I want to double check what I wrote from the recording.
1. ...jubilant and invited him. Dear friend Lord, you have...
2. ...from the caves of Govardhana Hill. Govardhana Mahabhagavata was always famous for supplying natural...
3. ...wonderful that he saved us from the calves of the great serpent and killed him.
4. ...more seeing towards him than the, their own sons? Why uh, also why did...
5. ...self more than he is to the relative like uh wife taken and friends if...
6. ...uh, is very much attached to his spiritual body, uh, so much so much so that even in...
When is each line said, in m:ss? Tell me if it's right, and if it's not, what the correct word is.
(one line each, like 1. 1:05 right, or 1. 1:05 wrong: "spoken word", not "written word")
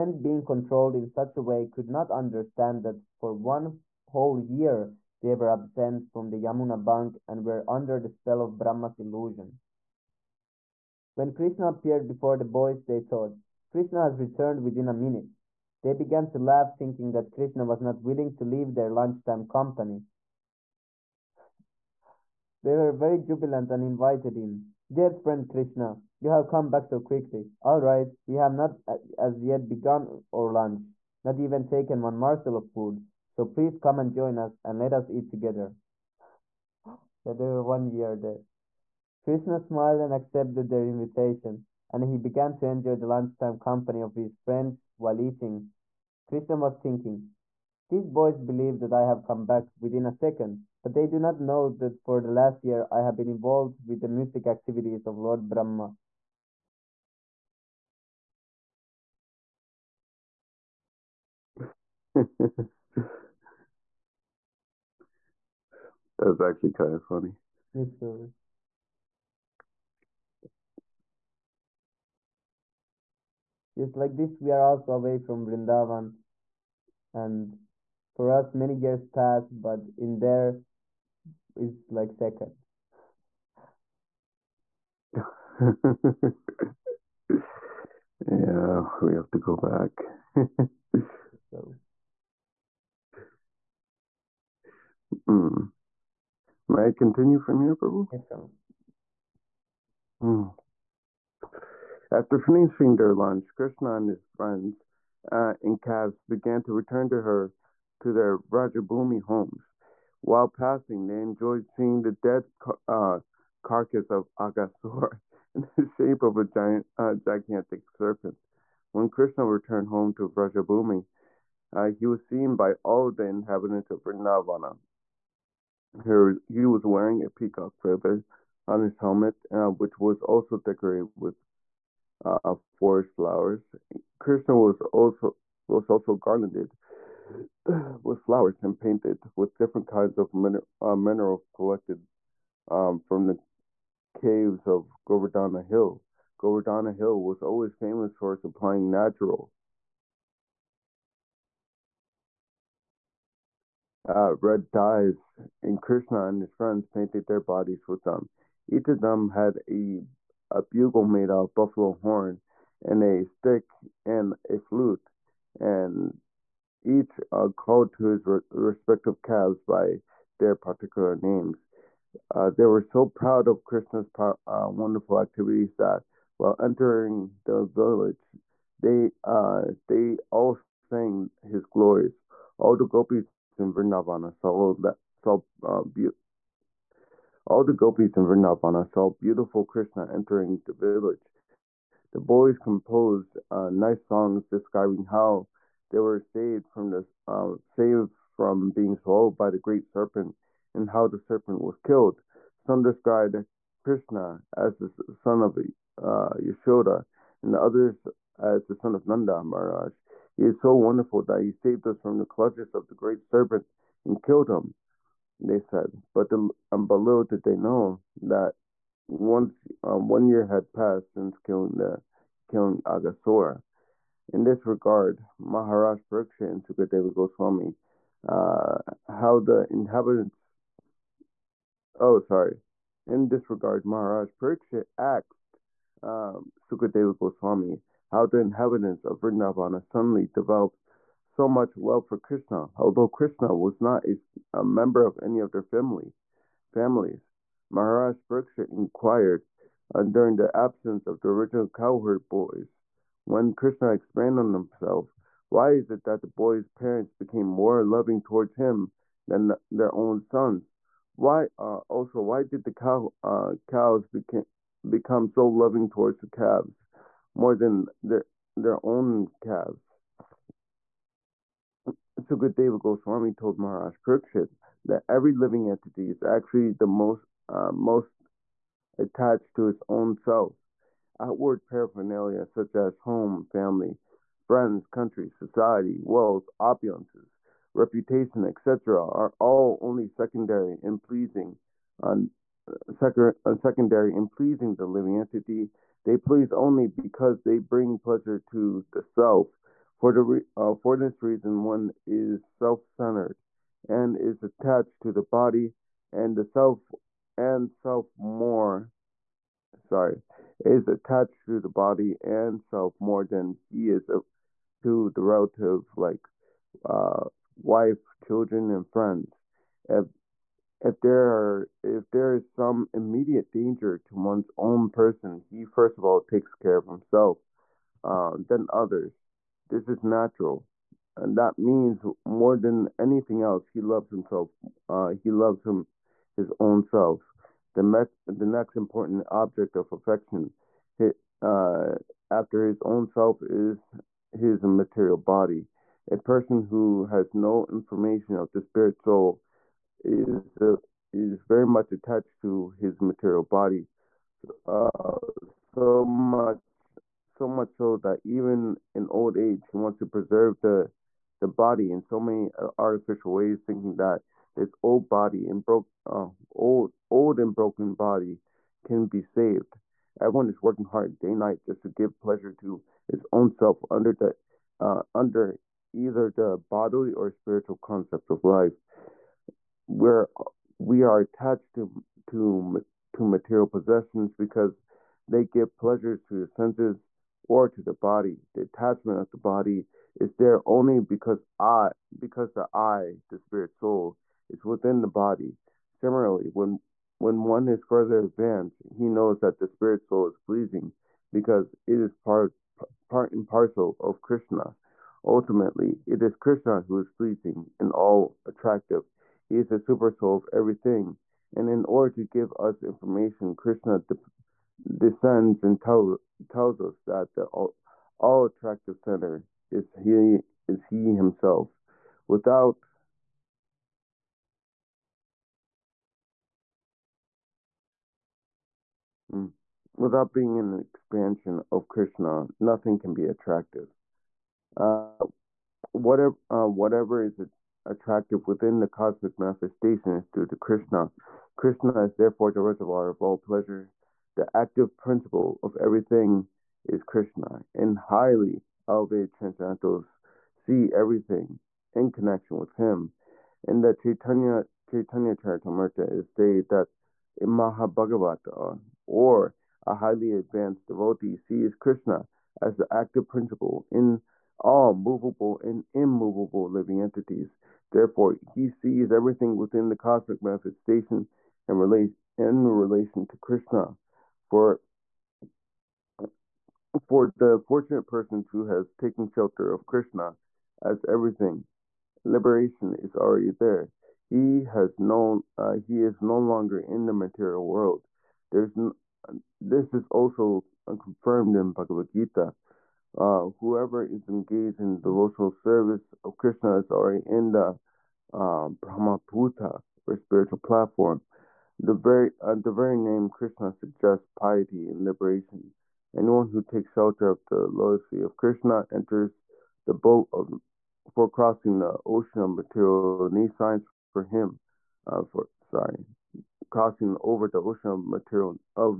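1. 0:23 wrong: "Krishna", not "Lord"
2. 2:23 wrong: "Hill", not "Mahabhagavata"
3. 3:30 wrong: "clutches", not "calves"
4. 4:17 wrong: "loving", not "seeing"
5. 5:12 wrong: "children", not "taken"
6. 5:50 wrong: "material", not "spiritual".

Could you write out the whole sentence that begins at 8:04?
He has known uh, he is no longer in the material world.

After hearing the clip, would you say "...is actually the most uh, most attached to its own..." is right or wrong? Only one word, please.
right.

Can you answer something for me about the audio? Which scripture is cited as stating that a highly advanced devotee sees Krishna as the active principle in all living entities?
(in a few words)
Chaitanya Charitamrita.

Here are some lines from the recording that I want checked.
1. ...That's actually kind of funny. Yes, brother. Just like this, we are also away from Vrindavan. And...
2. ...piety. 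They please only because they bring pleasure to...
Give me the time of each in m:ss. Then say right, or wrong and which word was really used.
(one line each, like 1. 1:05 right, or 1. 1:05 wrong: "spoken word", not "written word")
1. 1:06 right
2. 4:55 wrong: "entity", not "piety".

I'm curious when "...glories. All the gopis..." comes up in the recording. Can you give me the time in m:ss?
3:01.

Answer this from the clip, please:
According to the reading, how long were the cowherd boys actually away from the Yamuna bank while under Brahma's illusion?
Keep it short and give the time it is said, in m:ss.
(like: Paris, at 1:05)
one whole year, at 0:03.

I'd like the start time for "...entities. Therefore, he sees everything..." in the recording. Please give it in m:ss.
7:47.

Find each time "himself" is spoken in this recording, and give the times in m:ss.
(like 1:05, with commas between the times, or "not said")
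4:14, 5:26, 5:34, 7:01.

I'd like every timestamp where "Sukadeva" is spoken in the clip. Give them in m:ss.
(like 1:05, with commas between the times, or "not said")
3:46, 3:56, 4:32.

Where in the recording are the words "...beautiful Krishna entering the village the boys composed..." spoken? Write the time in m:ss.
3:09.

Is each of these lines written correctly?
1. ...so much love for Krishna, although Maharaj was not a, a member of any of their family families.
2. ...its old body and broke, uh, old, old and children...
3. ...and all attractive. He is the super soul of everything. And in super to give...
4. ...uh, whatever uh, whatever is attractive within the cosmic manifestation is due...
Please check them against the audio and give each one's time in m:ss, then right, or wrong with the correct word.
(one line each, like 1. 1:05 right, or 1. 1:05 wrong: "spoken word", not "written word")
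1. 4:01 wrong: "Krishna", not "Maharaj"
2. 6:04 wrong: "broken", not "children"
3. 6:47 wrong: "order", not "super"
4. 7:14 right.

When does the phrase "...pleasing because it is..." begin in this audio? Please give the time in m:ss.
6:40.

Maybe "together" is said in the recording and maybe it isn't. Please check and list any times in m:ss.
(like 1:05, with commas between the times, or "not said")
0:35.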